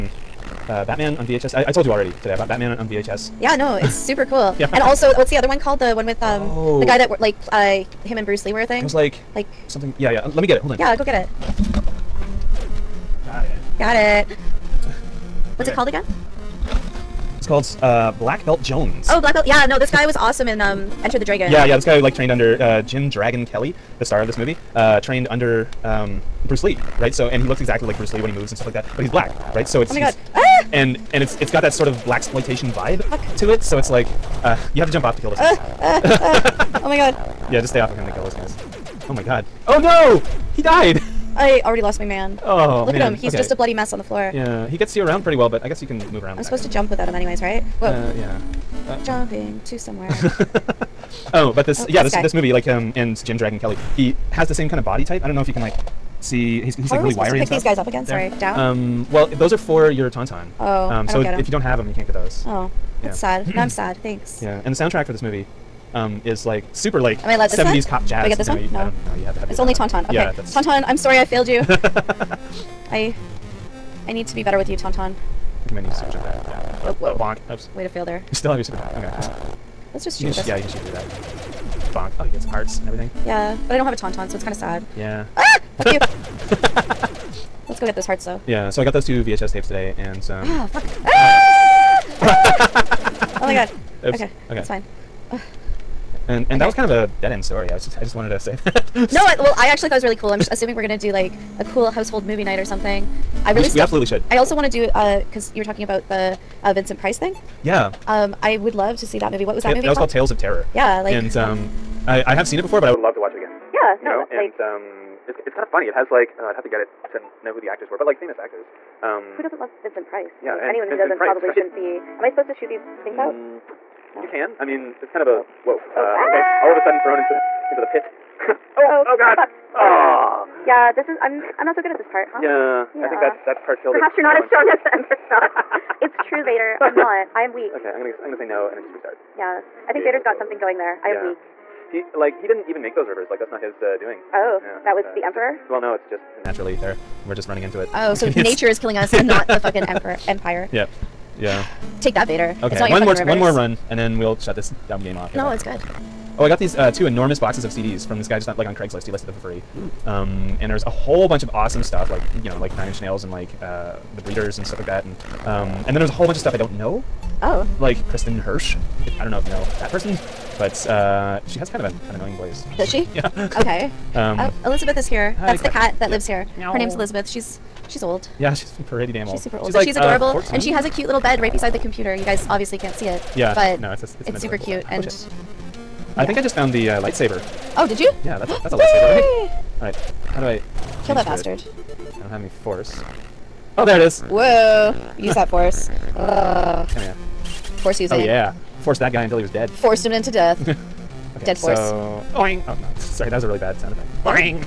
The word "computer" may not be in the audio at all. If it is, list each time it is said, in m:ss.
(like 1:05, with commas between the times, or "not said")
3:01.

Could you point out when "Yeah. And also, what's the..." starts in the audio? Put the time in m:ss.
0:04.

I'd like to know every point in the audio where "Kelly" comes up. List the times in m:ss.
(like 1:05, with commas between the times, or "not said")
0:23, 0:53.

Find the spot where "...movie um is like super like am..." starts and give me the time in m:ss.
1:05.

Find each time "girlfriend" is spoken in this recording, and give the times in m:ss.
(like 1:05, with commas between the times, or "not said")
not said.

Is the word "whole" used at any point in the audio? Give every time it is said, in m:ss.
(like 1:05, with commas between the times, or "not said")
2:40, 2:46.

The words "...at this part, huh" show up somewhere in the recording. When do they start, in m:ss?
2:11.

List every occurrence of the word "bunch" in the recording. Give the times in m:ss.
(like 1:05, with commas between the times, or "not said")
2:41, 2:46.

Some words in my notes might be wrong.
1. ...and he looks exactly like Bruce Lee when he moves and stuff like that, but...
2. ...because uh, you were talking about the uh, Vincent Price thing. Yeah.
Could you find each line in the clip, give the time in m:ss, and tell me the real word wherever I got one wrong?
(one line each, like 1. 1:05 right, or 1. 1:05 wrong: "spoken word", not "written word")
1. 0:27 right
2. 1:44 right.